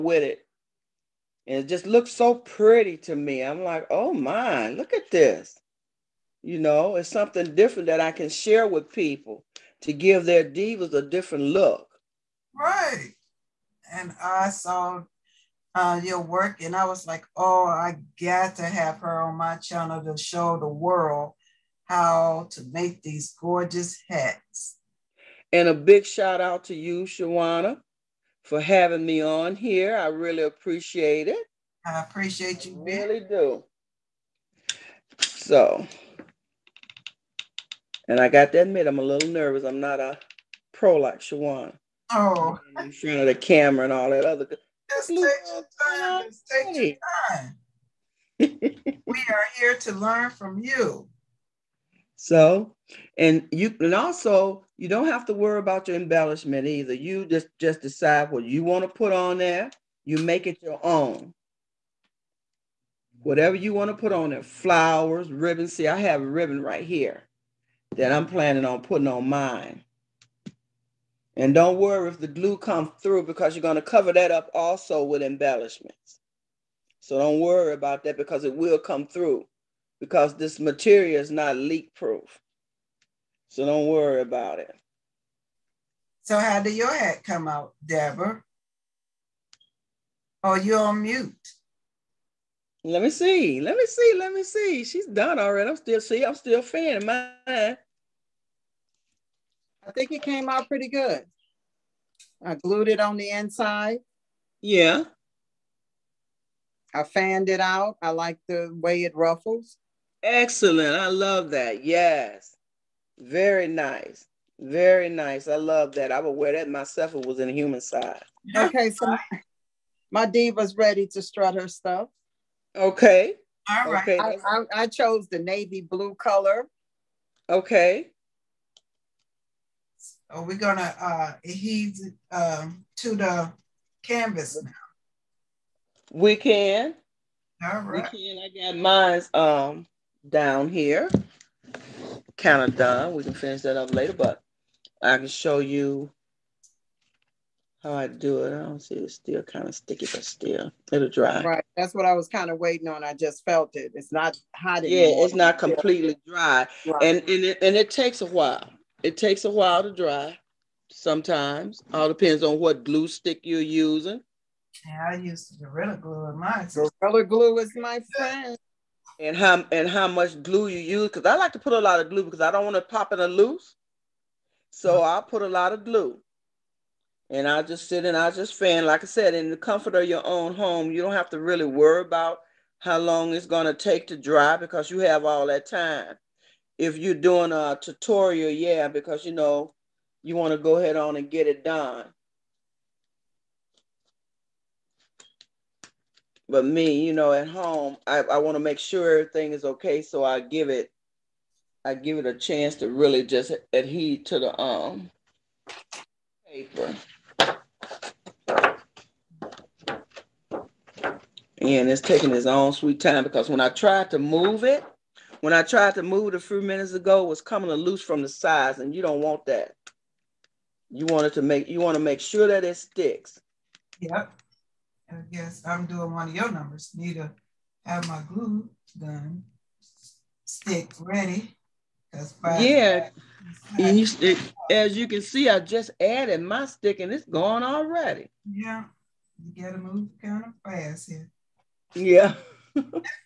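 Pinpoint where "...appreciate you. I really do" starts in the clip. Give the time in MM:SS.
00:31.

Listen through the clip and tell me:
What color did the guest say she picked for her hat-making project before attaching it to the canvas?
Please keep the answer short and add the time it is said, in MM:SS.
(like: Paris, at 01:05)
Navy blue, at 02:05.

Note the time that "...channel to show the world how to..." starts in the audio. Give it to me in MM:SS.
00:19.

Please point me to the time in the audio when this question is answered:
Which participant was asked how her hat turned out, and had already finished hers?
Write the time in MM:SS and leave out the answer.
01:27.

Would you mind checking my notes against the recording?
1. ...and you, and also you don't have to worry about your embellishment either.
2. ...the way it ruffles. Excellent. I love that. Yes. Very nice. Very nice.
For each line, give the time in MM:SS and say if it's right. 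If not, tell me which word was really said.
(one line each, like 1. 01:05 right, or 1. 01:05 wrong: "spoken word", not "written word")
1. 00:53 right
2. 01:48 right.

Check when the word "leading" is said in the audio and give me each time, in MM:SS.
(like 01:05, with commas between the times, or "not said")
not said.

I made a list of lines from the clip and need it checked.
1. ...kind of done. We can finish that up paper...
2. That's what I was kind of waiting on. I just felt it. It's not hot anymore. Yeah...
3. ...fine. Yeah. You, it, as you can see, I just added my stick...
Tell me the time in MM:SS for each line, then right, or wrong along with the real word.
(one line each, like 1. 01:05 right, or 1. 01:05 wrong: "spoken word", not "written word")
1. 02:22 wrong: "later", not "paper"
2. 02:31 right
3. 03:52 right.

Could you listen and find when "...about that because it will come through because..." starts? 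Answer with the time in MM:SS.
01:17.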